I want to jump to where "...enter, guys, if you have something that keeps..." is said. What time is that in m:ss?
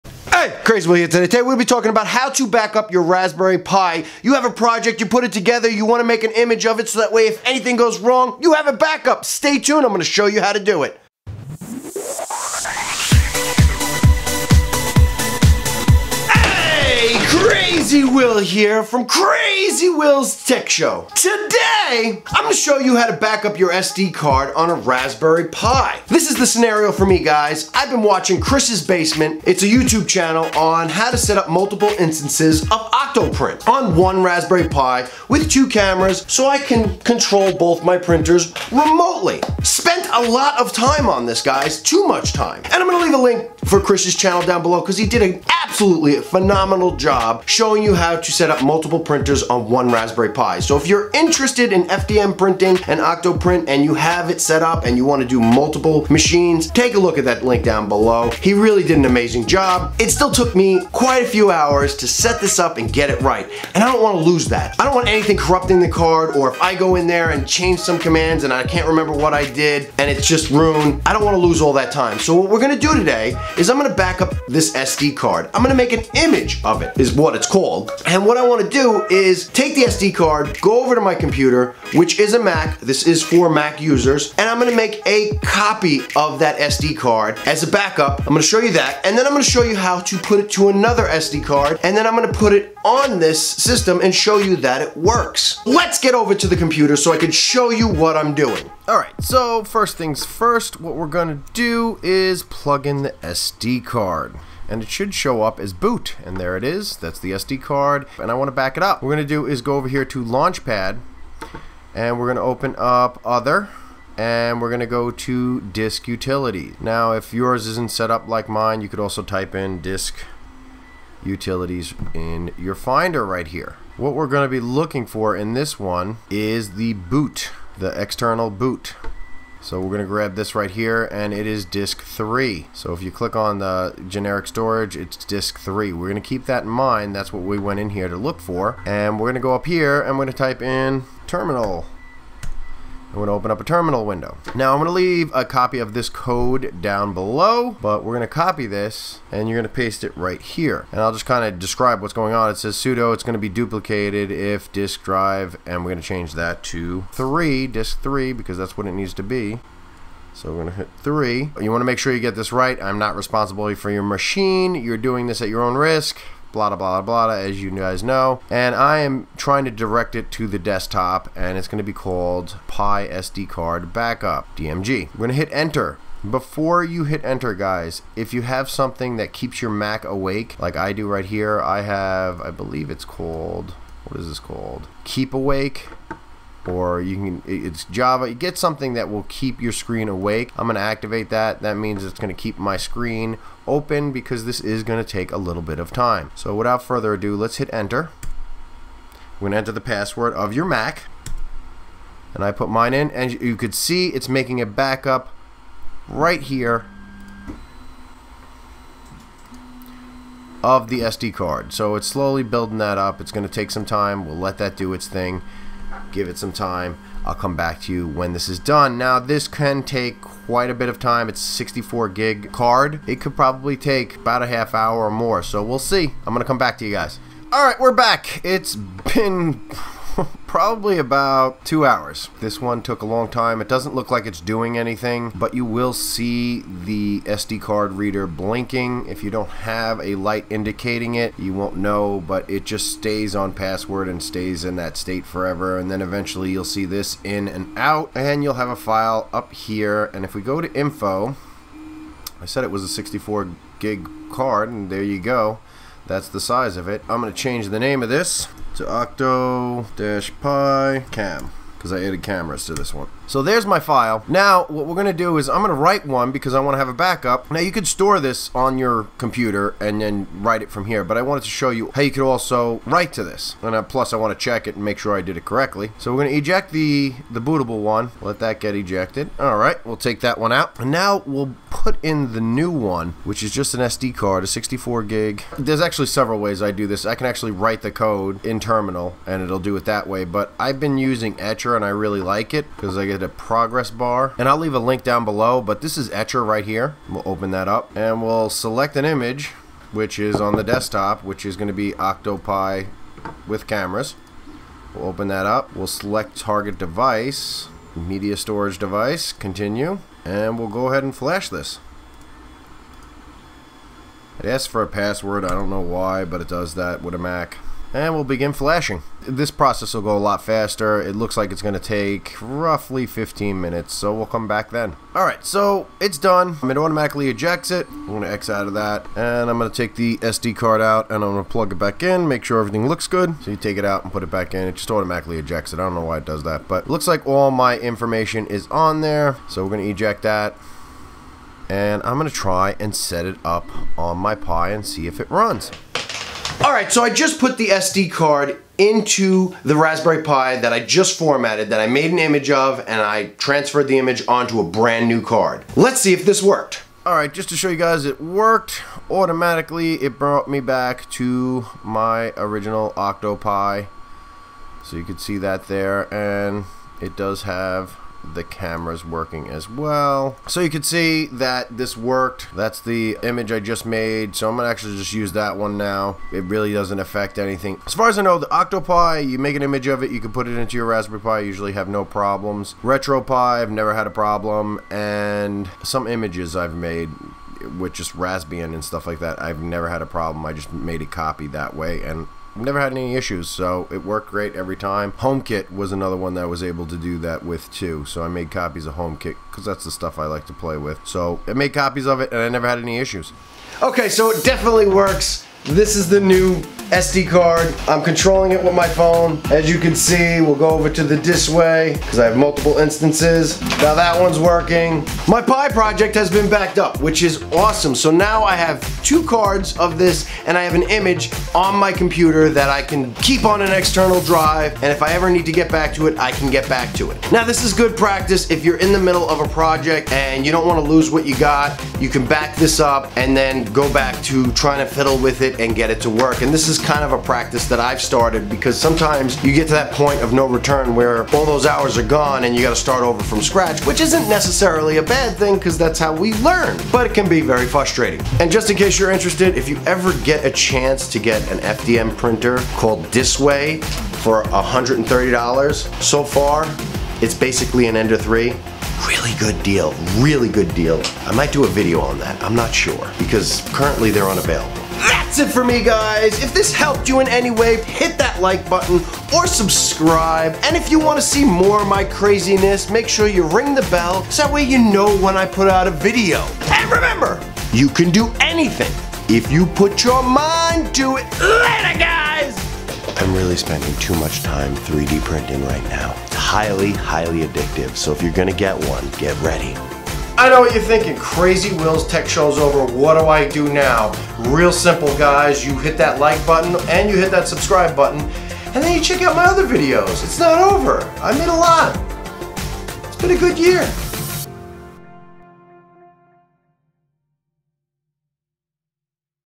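2:57.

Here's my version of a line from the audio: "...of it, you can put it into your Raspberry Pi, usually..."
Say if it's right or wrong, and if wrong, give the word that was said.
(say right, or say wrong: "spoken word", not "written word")
right.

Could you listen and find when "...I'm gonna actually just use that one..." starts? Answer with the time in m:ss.
6:14.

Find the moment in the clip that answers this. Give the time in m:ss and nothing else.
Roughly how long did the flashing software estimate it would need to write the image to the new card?
5:23.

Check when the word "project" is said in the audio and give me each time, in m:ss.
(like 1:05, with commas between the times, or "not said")
0:04, 6:55, 7:09.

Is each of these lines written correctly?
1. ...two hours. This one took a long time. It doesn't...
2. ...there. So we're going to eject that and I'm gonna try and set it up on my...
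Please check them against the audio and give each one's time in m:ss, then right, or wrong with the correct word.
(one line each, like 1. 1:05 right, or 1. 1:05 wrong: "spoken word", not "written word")
1. 3:51 right
2. 5:39 right.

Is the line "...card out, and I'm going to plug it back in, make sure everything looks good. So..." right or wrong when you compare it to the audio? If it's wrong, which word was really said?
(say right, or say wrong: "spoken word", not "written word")
right.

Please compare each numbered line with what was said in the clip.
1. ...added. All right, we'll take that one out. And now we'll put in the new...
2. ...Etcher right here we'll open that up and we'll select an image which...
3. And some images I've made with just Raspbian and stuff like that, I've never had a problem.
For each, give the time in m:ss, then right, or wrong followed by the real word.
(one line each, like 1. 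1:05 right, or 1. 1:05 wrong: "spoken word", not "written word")
1. 4:38 wrong: "ejected", not "added"
2. 4:56 right
3. 6:24 right.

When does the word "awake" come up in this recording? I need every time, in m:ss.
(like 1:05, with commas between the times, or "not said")
3:00, 3:05, 3:10.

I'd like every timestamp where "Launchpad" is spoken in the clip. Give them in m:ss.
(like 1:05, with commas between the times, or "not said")
1:50.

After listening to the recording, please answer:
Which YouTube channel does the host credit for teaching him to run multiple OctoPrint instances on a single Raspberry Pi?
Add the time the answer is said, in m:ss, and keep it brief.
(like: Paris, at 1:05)
Chris's Basement, at 0:28.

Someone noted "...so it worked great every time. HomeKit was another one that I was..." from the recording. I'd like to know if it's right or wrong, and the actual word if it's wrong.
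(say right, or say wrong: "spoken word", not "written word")
right.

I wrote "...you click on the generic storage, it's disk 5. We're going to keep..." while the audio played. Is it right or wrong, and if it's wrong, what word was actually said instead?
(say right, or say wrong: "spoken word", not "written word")
wrong: "3", not "5".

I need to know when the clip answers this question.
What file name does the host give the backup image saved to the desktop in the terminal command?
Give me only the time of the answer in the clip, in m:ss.
2:52.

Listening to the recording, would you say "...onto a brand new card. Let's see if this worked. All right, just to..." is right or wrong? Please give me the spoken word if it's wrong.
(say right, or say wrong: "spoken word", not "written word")
right.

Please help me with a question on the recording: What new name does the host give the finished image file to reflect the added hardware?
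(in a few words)
octo-pi cam.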